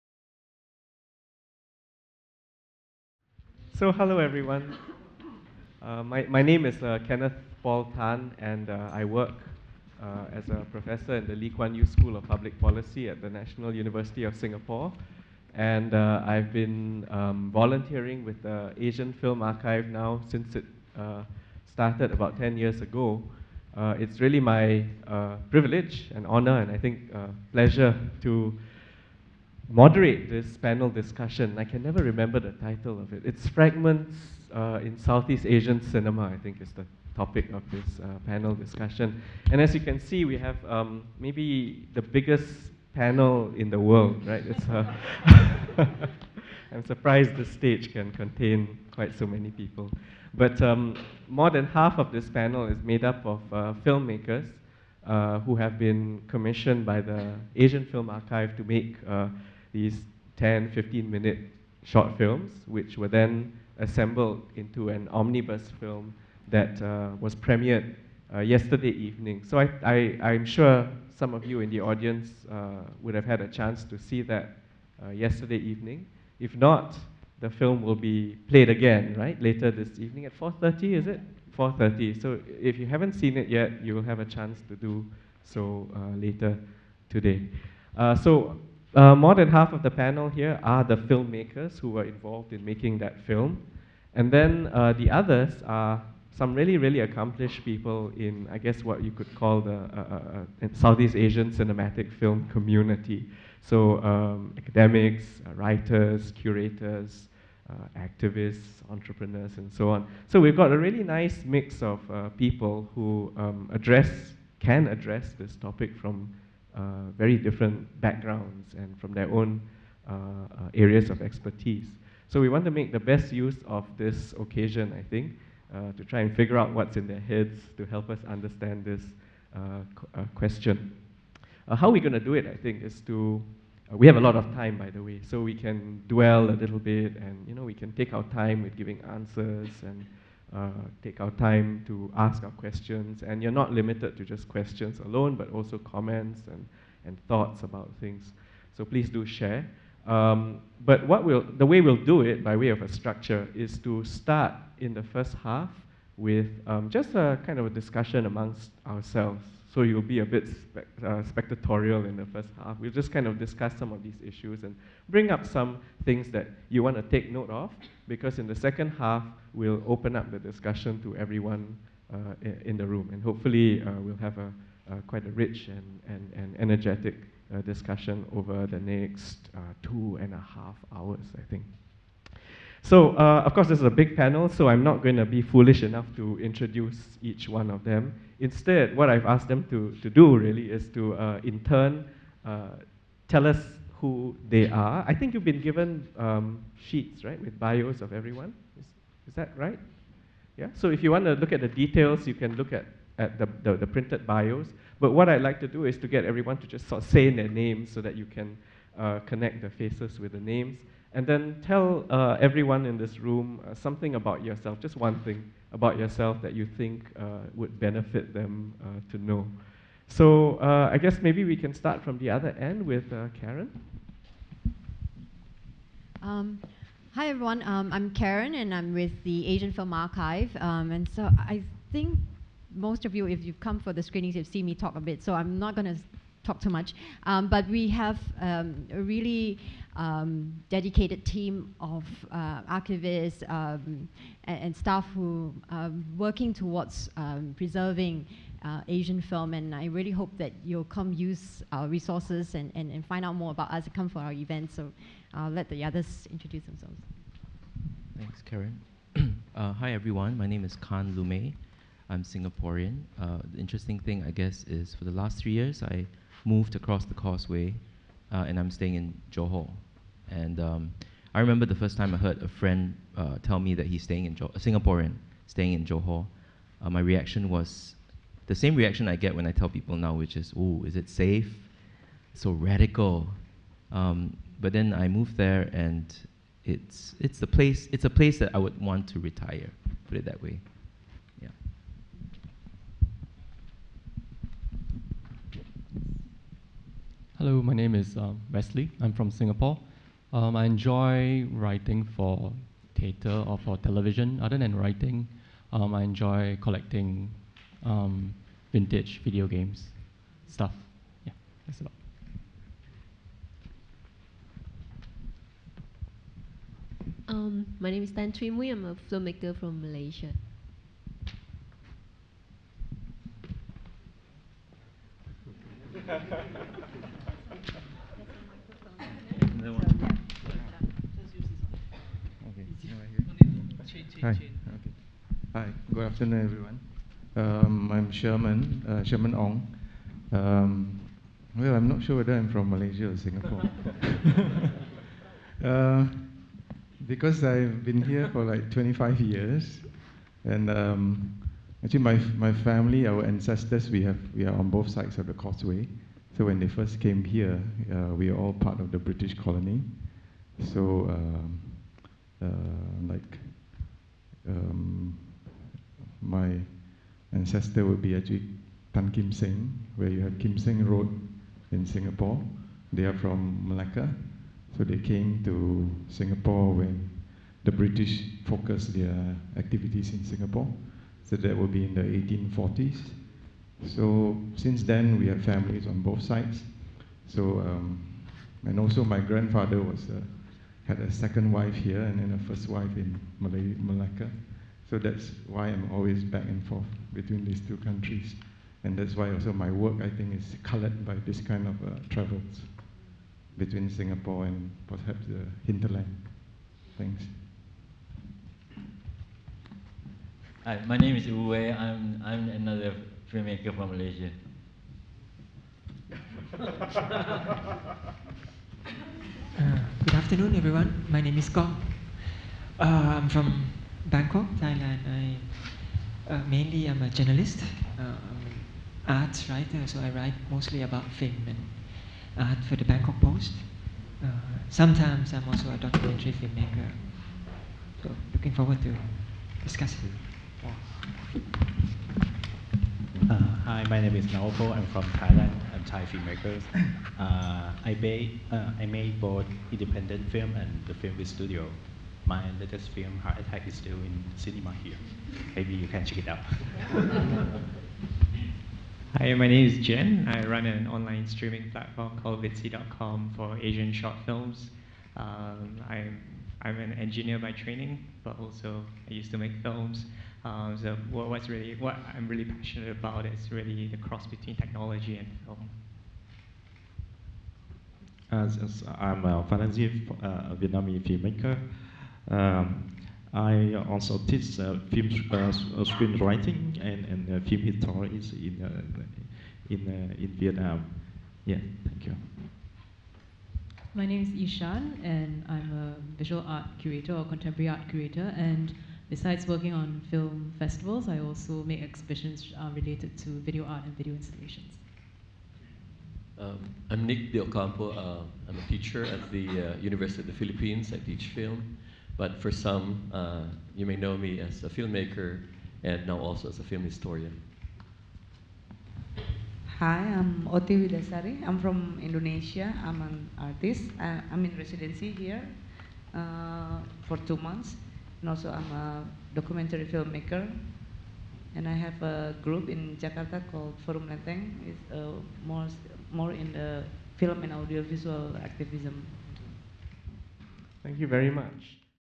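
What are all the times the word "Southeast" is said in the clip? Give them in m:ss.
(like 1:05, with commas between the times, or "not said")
0:34, 1:40.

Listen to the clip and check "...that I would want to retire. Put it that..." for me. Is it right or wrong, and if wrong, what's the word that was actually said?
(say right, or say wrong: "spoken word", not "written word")
right.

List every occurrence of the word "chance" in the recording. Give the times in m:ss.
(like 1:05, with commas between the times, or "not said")
1:13, 1:24.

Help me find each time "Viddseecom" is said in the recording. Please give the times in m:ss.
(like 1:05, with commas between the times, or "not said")
7:42.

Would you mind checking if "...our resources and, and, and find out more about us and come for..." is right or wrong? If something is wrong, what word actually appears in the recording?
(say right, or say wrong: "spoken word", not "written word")
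right.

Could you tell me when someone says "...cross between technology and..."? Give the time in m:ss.
7:53.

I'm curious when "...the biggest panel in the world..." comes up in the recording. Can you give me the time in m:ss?
0:41.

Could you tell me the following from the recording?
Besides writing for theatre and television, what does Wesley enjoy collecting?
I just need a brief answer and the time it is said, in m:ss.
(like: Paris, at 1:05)
vintage video games, at 5:08.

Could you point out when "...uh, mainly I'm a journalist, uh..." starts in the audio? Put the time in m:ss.
7:06.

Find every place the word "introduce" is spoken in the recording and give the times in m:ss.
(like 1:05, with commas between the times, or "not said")
3:06, 4:16.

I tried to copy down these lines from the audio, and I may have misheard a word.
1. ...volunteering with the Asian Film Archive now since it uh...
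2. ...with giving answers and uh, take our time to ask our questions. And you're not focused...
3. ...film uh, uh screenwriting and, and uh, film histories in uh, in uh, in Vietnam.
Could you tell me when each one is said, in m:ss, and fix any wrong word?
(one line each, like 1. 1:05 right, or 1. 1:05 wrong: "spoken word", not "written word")
1. 0:17 right
2. 2:18 wrong: "limited", not "focused"
3. 8:04 right.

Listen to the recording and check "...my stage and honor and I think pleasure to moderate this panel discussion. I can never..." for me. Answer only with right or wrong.
wrong.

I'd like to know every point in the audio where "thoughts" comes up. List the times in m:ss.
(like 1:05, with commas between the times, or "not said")
2:27.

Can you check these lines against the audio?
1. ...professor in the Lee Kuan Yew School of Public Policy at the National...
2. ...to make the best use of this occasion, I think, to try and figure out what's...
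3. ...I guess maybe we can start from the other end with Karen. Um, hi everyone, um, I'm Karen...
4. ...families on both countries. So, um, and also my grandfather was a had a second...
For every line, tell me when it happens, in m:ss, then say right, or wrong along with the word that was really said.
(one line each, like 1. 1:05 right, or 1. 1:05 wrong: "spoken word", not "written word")
1. 0:10 right
2. 2:02 right
3. 3:40 right
4. 6:25 wrong: "sides", not "countries".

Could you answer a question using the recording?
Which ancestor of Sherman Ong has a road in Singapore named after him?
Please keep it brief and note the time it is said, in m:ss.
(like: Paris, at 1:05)
Tan Kim Seng, at 6:08.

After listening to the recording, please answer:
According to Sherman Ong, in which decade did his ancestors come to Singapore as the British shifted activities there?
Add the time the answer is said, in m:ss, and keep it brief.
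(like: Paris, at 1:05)
1840s, at 6:22.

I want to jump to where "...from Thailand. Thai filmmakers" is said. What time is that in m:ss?
7:24.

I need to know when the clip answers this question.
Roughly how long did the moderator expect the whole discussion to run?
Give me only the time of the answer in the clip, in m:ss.
2:59.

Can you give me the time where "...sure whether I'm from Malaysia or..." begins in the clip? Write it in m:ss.
5:42.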